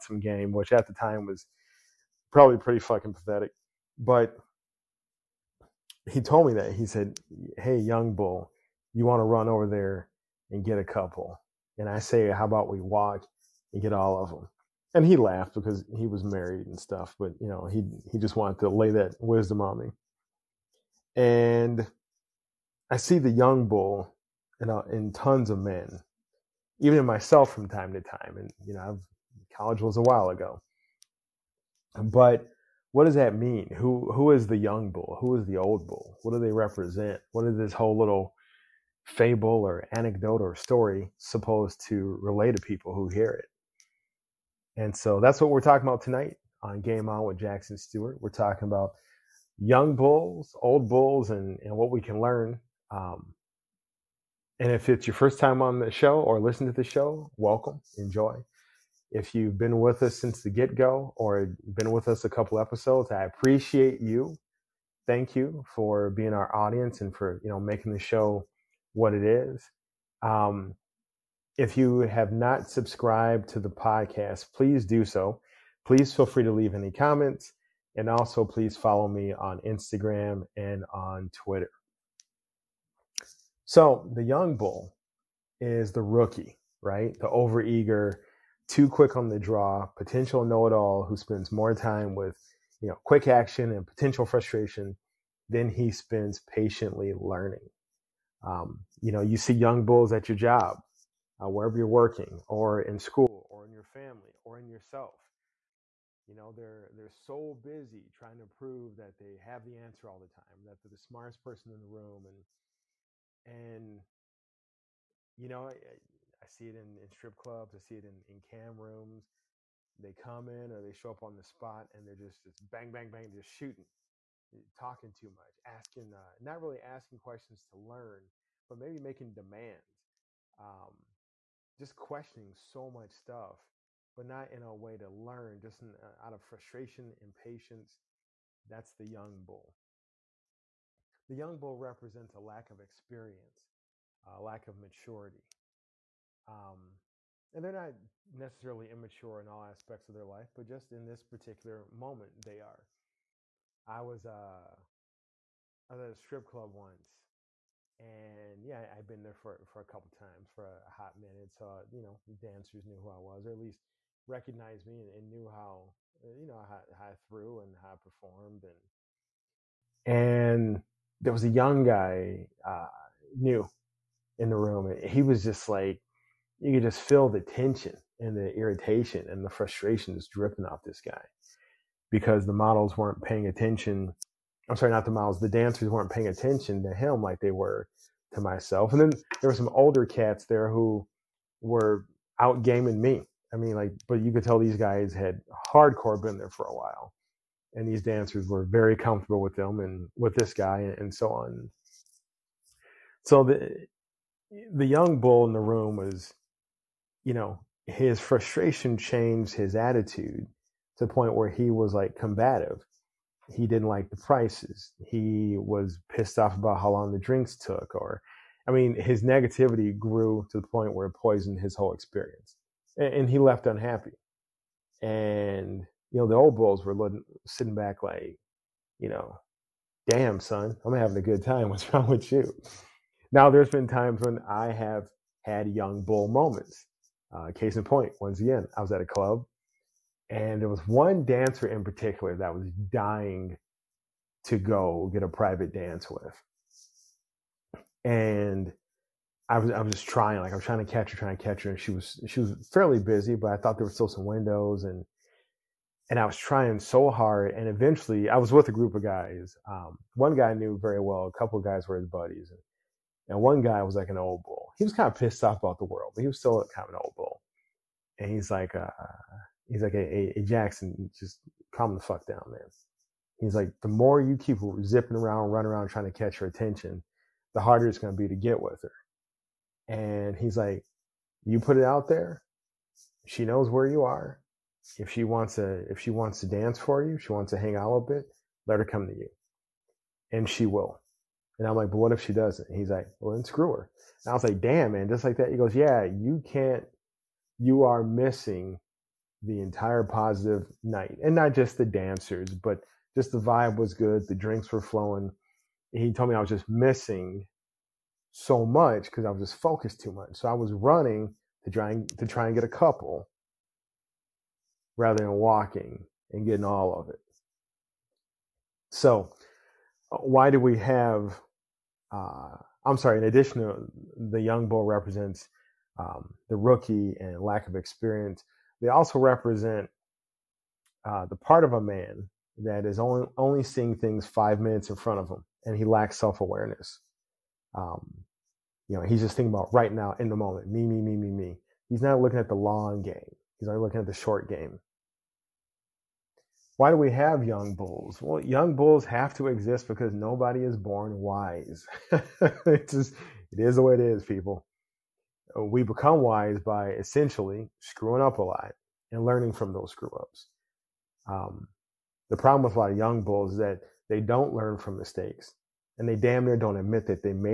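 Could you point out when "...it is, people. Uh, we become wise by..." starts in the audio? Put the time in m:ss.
5:53.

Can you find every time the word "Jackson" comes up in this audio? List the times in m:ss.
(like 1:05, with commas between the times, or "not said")
0:47, 4:30.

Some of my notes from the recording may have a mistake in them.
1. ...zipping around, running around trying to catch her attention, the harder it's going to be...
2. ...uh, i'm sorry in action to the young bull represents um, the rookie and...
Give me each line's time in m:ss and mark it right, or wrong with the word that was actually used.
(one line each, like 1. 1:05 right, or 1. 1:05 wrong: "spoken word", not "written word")
1. 4:34 right
2. 5:22 wrong: "addition", not "action".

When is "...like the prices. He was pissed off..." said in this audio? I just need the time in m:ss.
3:33.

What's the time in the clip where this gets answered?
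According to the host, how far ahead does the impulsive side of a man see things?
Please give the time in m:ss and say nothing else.
5:34.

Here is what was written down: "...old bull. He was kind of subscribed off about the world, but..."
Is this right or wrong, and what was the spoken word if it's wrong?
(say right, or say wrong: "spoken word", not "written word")
wrong: "pissed", not "subscribed".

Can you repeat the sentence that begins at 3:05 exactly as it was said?
The dancers weren't paying attention to him like they were to myself.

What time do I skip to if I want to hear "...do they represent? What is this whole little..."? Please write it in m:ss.
0:36.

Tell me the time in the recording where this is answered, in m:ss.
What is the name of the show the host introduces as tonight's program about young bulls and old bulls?
0:46.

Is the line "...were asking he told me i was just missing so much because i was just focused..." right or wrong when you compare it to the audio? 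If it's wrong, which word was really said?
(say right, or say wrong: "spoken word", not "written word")
wrong: "flowing", not "asking".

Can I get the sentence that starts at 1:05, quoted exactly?
Thank you for being our audience and for you know making the show what it is.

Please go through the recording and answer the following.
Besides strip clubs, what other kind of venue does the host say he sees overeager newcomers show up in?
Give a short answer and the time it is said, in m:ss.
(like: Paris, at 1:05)
cam rooms, at 1:58.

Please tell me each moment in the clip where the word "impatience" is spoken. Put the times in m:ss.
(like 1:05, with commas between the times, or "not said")
2:17.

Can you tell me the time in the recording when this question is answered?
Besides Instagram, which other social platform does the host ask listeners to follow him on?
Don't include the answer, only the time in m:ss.
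1:21.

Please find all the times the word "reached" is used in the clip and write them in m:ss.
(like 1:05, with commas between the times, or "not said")
not said.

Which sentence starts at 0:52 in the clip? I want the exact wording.
Um, and if it's your first time on the show or listen to the show, welcome, enjoy.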